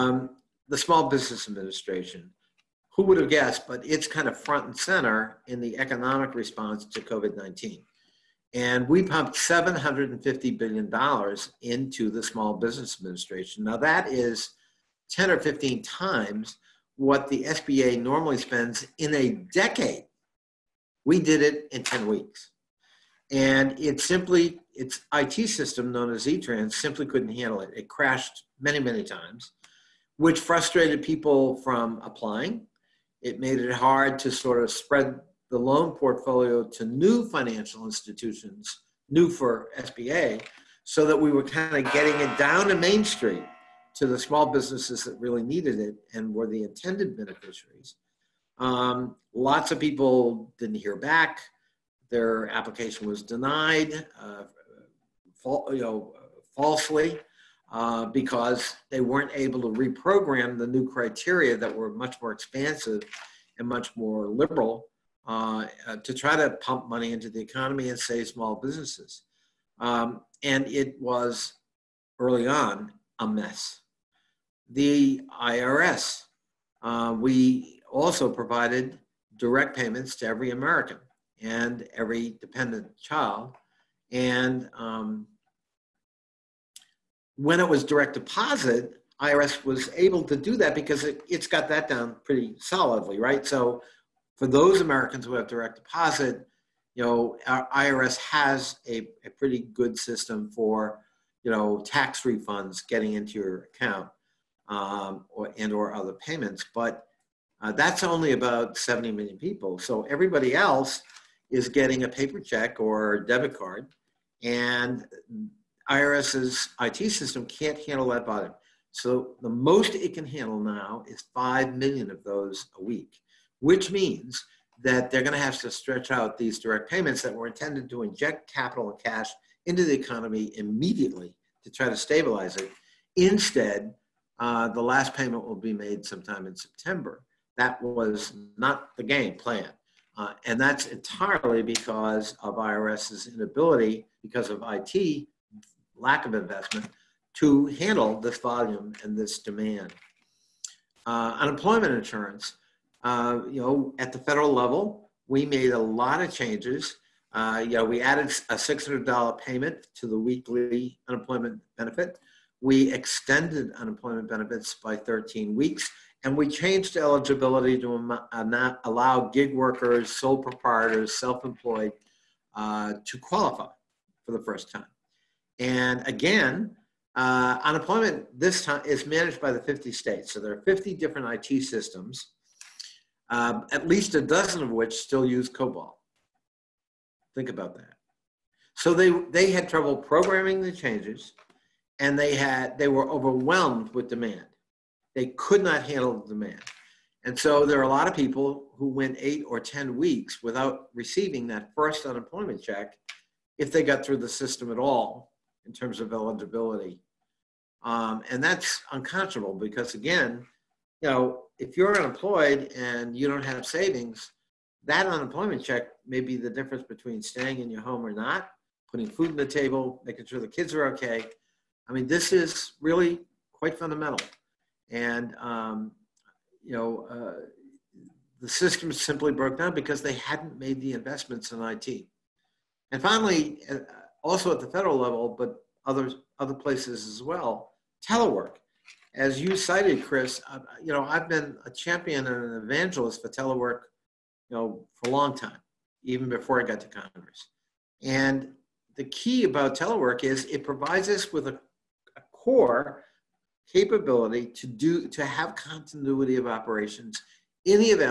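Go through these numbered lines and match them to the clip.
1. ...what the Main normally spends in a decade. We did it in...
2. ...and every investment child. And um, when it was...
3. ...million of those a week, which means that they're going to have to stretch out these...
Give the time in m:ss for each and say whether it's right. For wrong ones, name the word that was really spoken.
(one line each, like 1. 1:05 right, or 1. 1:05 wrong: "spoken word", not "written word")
1. 0:16 wrong: "SBA", not "Main"
2. 1:21 wrong: "dependent", not "investment"
3. 2:01 right.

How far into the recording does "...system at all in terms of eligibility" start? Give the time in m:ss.
3:24.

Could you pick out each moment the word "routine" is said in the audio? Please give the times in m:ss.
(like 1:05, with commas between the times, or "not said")
not said.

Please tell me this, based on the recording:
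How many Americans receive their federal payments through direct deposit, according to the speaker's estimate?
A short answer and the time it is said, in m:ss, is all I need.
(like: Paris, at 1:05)
70 million, at 1:48.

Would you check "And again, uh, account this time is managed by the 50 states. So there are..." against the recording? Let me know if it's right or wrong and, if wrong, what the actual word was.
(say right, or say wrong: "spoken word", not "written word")
wrong: "unemployment", not "account".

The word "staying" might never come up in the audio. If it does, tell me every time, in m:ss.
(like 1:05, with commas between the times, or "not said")
3:37.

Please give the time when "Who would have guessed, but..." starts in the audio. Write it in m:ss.
0:02.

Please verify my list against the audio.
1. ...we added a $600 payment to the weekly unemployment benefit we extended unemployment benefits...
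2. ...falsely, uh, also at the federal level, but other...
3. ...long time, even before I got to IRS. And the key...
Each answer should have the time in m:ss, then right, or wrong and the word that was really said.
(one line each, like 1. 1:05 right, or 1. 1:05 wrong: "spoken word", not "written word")
1. 2:37 right
2. 3:53 wrong: "finally", not "falsely"
3. 4:05 wrong: "Congress", not "IRS".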